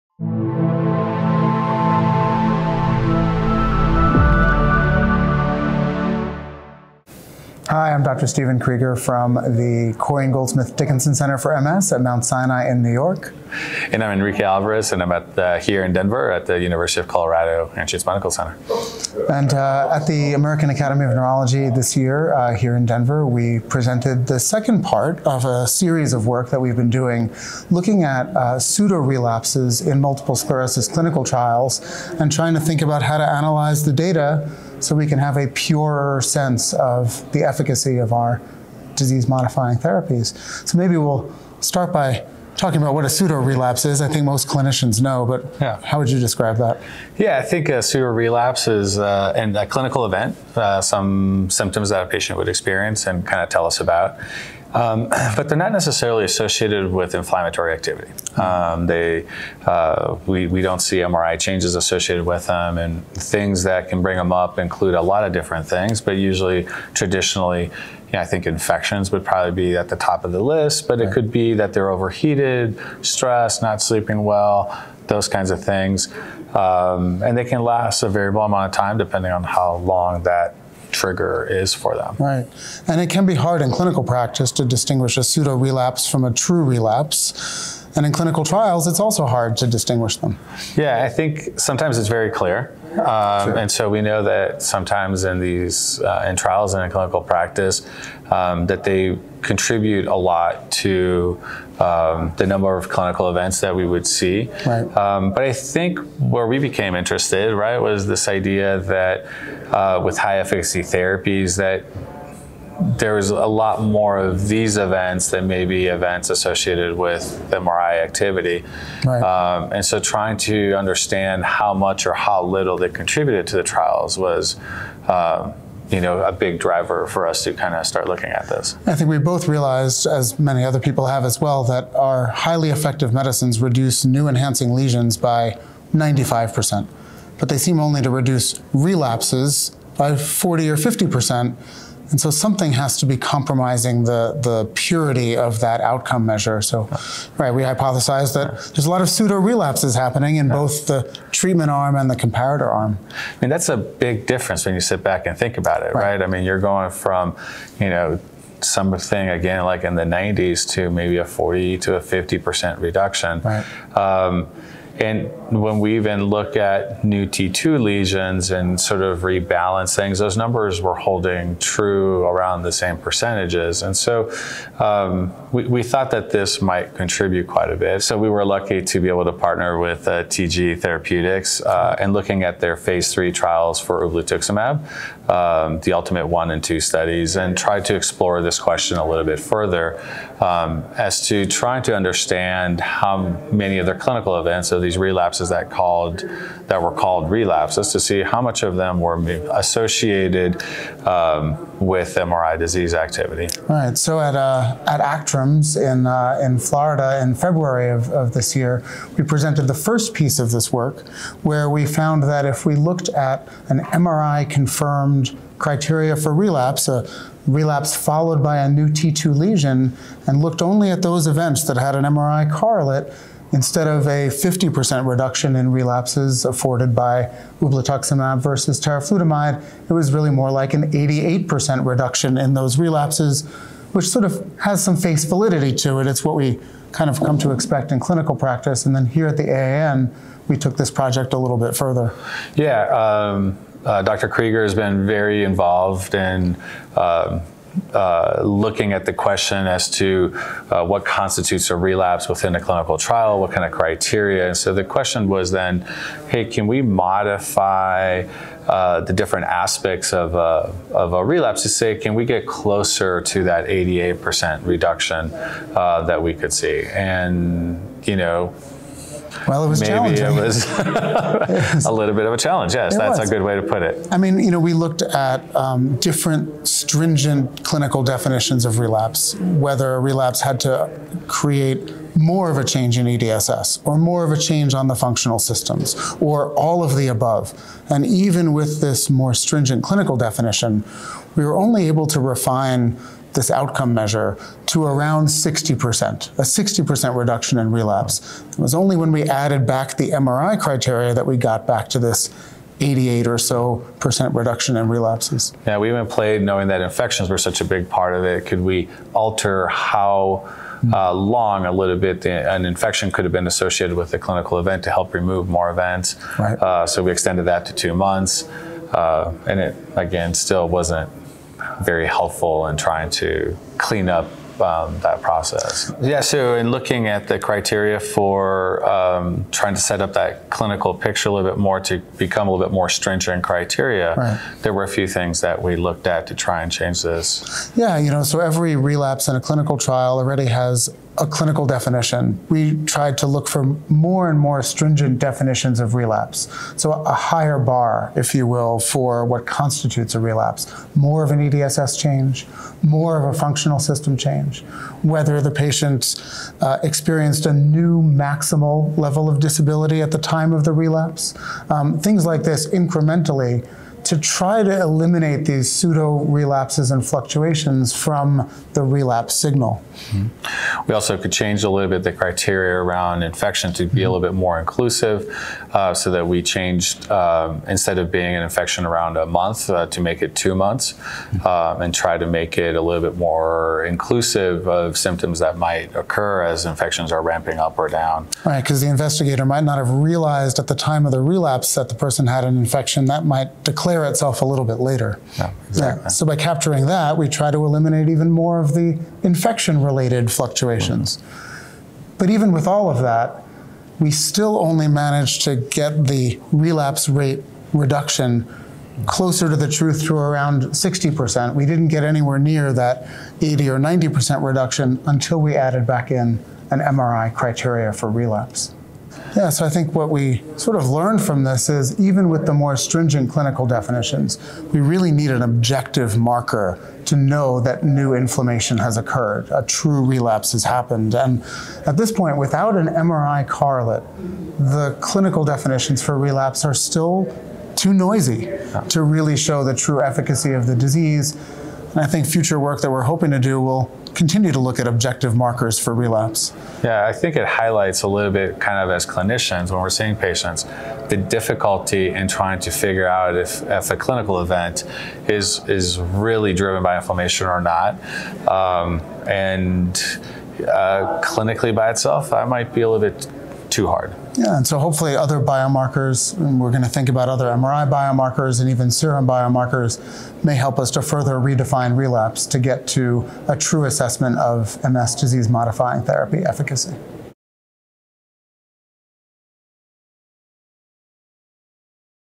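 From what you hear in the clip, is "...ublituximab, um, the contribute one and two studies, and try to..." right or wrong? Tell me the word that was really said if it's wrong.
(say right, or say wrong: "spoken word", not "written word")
wrong: "ultimate", not "contribute".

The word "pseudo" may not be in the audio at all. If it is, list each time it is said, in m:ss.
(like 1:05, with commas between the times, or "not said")
0:28, 0:43, 0:47, 1:25, 2:29, 6:05.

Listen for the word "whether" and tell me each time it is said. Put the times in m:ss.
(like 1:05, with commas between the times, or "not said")
4:39, 5:55.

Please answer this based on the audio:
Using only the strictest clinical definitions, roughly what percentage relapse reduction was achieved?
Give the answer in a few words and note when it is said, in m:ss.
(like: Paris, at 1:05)
60%, at 4:56.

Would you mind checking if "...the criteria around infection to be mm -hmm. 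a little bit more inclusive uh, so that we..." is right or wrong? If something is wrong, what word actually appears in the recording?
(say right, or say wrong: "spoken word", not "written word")
right.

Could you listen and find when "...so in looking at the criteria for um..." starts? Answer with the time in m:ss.
5:26.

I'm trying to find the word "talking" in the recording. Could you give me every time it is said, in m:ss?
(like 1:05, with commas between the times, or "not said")
0:42.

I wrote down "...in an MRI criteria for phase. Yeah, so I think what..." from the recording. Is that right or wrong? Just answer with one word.
wrong.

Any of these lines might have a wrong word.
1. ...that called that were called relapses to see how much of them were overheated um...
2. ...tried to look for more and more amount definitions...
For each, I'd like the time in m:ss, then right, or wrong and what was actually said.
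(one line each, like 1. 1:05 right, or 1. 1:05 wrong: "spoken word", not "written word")
1. 3:15 wrong: "associated", not "overheated"
2. 5:42 wrong: "stringent", not "amount".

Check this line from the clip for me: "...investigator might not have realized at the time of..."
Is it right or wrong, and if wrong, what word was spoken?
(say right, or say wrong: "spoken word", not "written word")
right.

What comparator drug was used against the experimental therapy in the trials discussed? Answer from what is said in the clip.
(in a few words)
teriflunomide.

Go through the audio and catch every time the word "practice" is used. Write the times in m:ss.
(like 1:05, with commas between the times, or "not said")
1:24, 1:37, 3:58.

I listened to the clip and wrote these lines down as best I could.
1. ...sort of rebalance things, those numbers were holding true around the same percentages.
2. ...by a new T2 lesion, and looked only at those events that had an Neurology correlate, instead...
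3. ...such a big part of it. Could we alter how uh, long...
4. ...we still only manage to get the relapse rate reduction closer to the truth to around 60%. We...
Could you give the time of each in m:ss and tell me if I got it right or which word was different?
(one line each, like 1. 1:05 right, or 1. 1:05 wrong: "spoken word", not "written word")
1. 2:48 right
2. 3:38 wrong: "MRI", not "Neurology"
3. 5:07 right
4. 6:43 right.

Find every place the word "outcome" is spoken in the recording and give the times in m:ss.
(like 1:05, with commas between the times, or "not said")
2:25, 4:53.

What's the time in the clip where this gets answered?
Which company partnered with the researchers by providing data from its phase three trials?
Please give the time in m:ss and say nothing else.
3:00.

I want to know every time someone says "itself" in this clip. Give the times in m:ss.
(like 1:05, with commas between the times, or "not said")
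6:34, 7:41.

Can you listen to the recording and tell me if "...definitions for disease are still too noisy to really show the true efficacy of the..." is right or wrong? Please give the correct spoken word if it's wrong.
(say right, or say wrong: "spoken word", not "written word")
wrong: "relapse", not "disease".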